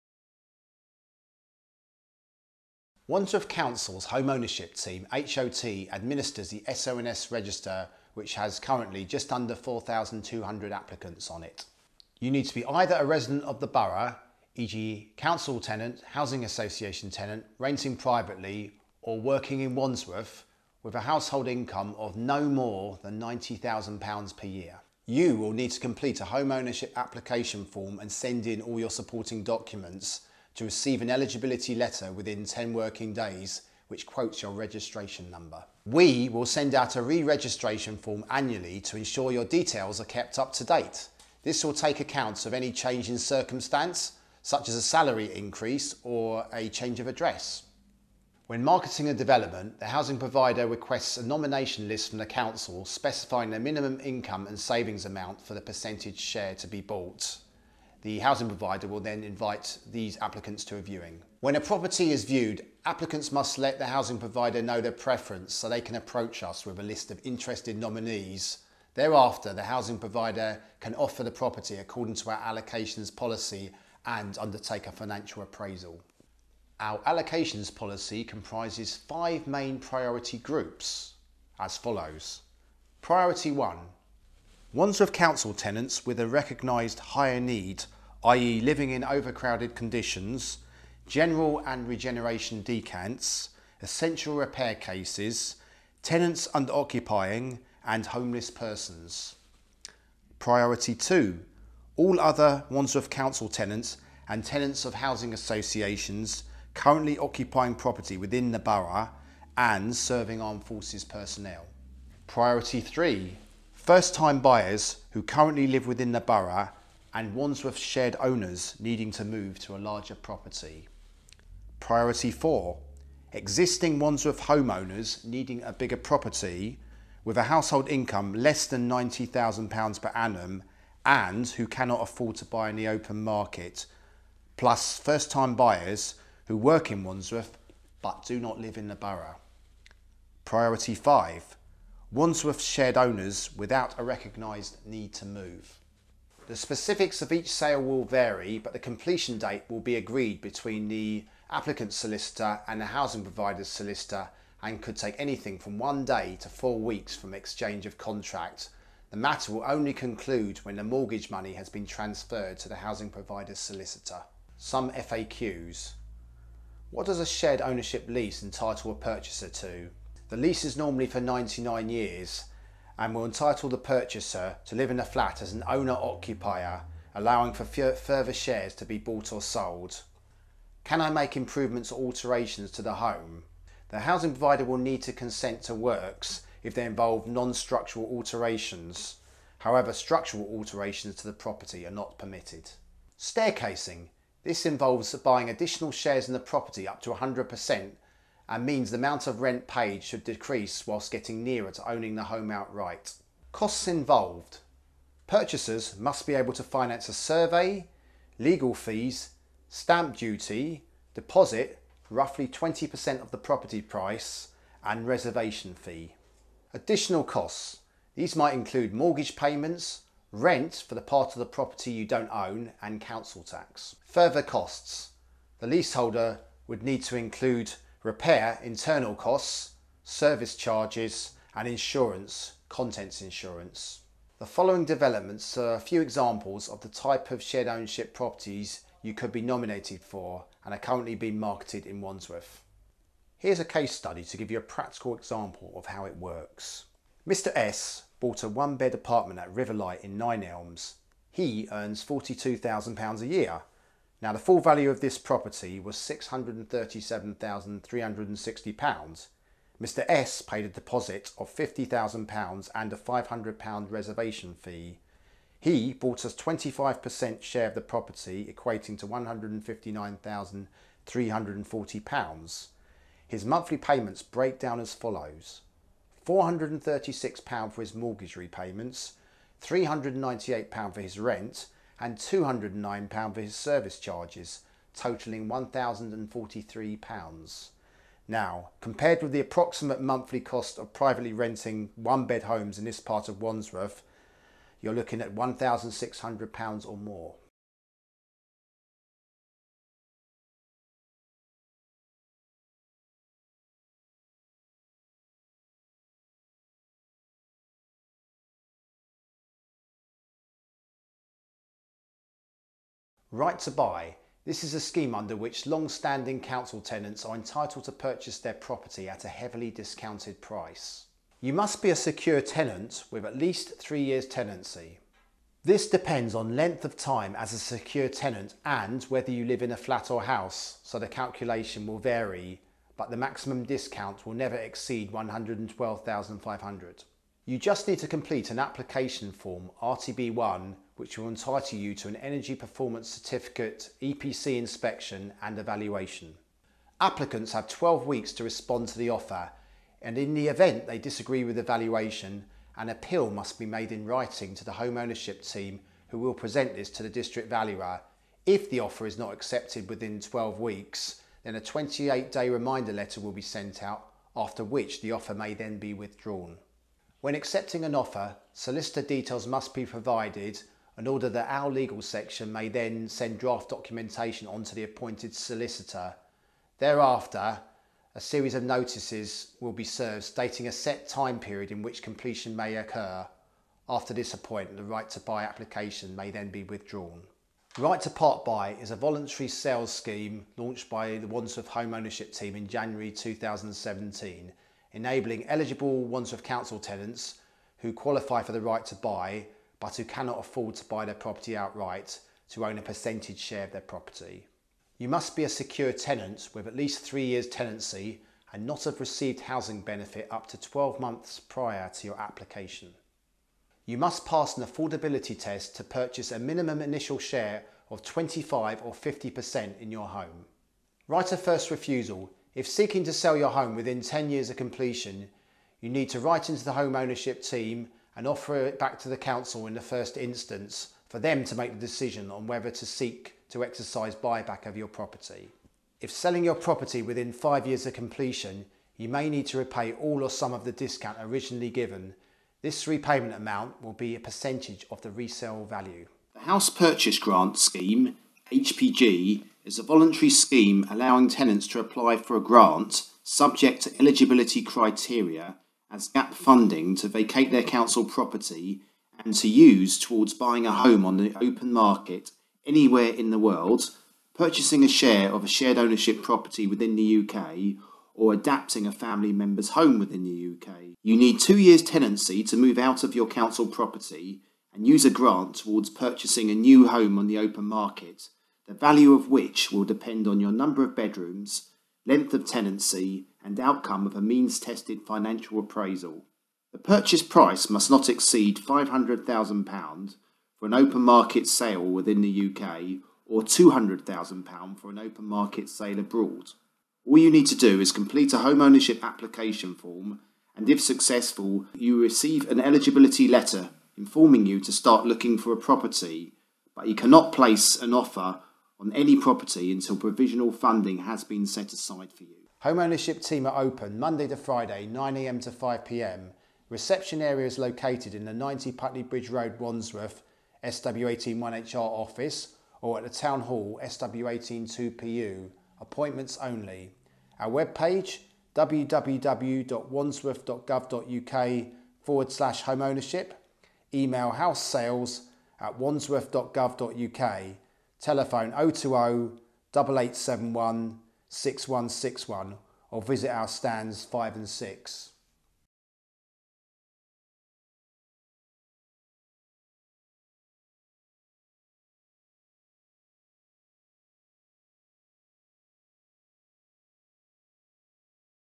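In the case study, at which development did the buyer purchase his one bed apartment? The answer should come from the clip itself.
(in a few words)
Riverlight.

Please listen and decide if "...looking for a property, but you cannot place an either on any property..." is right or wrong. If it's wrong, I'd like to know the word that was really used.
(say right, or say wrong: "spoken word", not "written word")
wrong: "offer", not "either".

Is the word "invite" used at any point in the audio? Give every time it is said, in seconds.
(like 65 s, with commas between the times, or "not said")
59 s.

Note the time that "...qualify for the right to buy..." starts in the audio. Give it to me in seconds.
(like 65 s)
397 s.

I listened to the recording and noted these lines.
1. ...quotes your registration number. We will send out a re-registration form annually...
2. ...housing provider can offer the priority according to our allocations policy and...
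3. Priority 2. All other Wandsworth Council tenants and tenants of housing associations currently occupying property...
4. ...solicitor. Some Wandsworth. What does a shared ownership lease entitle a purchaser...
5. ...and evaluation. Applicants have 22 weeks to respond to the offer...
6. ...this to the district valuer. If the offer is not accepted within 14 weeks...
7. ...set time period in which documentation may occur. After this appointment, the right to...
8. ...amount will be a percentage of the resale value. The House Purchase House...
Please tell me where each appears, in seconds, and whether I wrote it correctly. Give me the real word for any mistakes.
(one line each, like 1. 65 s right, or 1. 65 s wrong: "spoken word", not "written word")
1. 34 s right
2. 69 s wrong: "property", not "priority"
3. 100 s right
4. 163 s wrong: "FAQs", not "Wandsworth"
5. 345 s wrong: "12", not "22"
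6. 356 s wrong: "12", not "14"
7. 380 s wrong: "completion", not "documentation"
8. 443 s wrong: "Grant", not "House".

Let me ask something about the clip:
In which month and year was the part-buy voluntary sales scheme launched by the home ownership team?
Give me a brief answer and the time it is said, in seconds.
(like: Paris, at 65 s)
January 2017, at 392 s.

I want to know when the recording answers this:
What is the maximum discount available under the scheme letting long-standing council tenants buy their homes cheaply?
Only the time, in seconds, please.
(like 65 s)
335 s.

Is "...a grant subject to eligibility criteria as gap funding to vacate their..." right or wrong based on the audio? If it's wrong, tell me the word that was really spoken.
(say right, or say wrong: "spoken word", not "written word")
right.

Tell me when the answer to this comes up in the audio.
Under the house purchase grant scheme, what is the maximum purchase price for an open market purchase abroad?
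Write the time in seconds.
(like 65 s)
493 s.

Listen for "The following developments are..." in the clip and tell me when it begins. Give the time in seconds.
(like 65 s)
234 s.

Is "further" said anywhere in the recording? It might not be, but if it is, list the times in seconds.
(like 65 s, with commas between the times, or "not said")
177 s, 224 s.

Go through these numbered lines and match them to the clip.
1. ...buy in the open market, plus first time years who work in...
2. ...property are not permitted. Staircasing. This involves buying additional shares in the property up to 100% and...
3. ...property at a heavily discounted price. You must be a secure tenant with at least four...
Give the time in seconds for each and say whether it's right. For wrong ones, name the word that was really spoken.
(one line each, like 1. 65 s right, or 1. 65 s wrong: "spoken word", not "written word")
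1. 132 s wrong: "buyers", not "years"
2. 191 s right
3. 318 s wrong: "three", not "four".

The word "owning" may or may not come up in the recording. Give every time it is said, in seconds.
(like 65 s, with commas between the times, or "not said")
201 s.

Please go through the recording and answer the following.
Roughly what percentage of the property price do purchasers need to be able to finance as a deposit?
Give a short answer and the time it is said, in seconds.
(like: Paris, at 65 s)
20%, at 212 s.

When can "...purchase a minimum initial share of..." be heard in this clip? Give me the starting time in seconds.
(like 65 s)
415 s.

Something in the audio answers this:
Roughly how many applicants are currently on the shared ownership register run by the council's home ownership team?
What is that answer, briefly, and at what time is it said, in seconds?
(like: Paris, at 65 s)
4,200, at 9 s.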